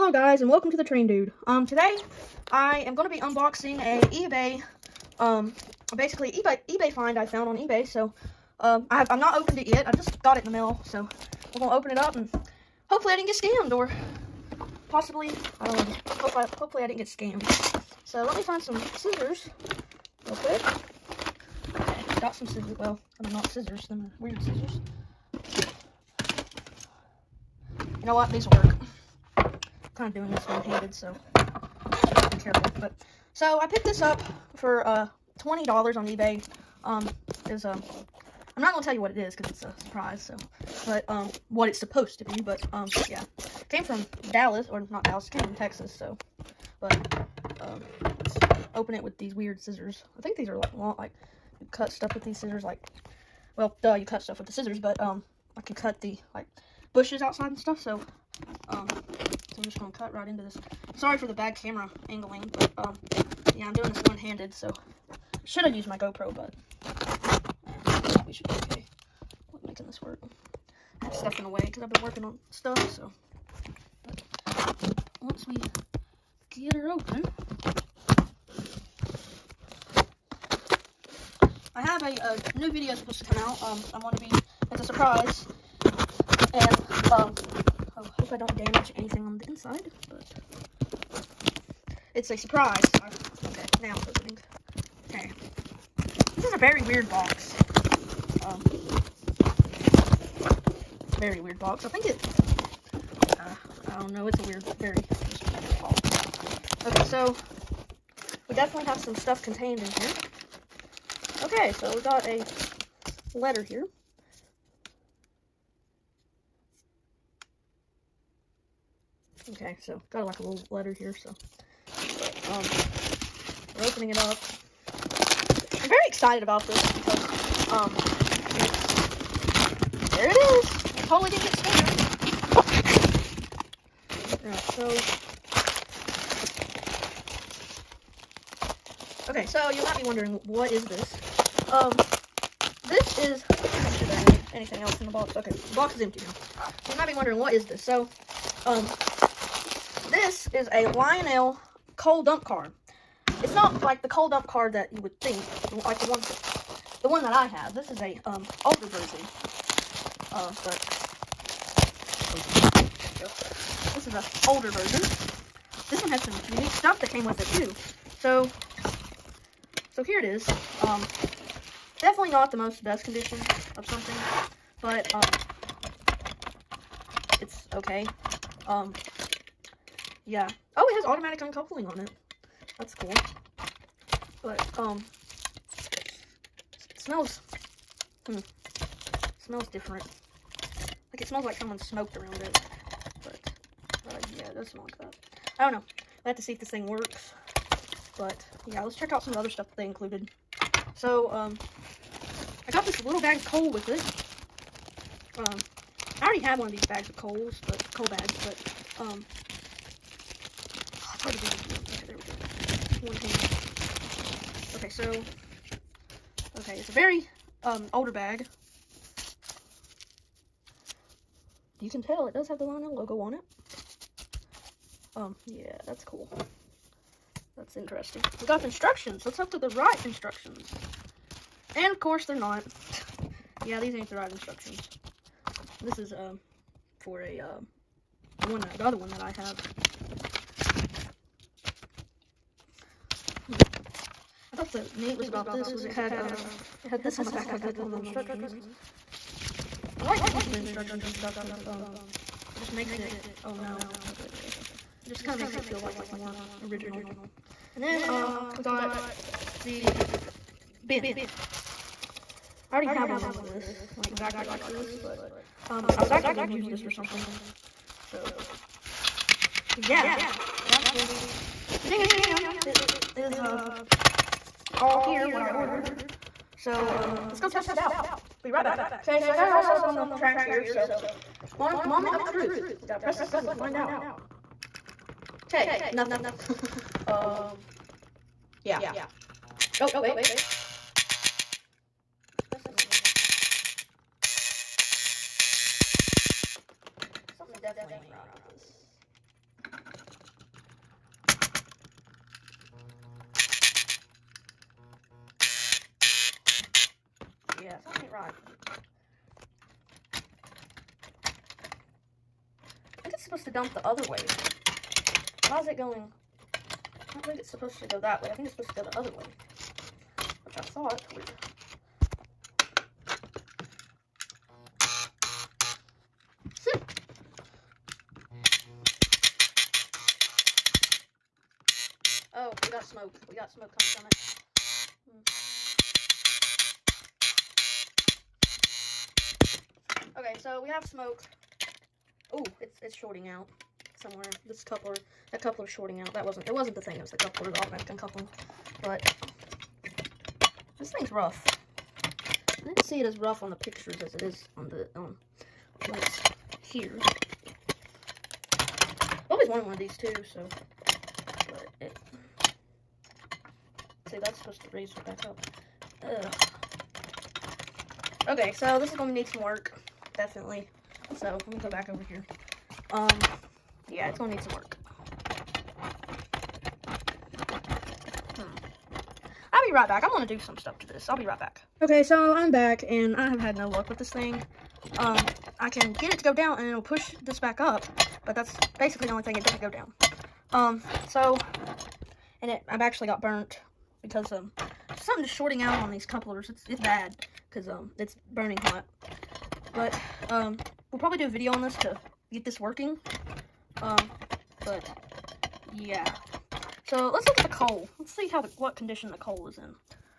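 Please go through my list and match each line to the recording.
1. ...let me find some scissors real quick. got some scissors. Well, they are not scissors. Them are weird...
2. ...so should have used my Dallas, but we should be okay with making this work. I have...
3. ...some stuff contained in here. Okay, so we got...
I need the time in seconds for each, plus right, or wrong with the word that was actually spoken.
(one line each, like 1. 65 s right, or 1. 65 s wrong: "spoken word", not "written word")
1. 18 s right
2. 64 s wrong: "GoPro", not "Dallas"
3. 108 s right.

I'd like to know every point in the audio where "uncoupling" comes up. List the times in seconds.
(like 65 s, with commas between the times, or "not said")
181 s, 347 s.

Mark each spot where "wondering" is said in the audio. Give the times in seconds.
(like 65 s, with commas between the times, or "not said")
140 s, 147 s.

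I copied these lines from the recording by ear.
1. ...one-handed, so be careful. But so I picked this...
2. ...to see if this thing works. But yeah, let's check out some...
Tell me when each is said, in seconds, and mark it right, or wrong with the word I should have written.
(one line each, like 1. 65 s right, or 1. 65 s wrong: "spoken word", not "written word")
1. 30 s right
2. 196 s right.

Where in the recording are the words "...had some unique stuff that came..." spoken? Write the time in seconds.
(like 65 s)
166 s.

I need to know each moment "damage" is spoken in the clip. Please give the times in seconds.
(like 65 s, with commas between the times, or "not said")
88 s.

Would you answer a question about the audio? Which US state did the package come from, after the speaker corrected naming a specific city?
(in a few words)
Texas.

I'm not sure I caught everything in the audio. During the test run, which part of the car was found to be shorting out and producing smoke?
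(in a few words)
the coupler.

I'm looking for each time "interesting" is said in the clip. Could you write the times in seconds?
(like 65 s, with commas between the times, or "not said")
227 s.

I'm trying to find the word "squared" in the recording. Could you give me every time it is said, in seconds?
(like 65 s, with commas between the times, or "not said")
not said.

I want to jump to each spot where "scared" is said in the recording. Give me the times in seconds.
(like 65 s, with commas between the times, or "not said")
131 s.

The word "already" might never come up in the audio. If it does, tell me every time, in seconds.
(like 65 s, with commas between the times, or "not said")
206 s, 262 s.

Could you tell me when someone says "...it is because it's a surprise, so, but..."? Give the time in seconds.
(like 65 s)
39 s.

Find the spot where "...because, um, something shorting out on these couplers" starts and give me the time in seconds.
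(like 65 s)
394 s.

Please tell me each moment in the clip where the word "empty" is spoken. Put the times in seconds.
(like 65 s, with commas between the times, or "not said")
145 s.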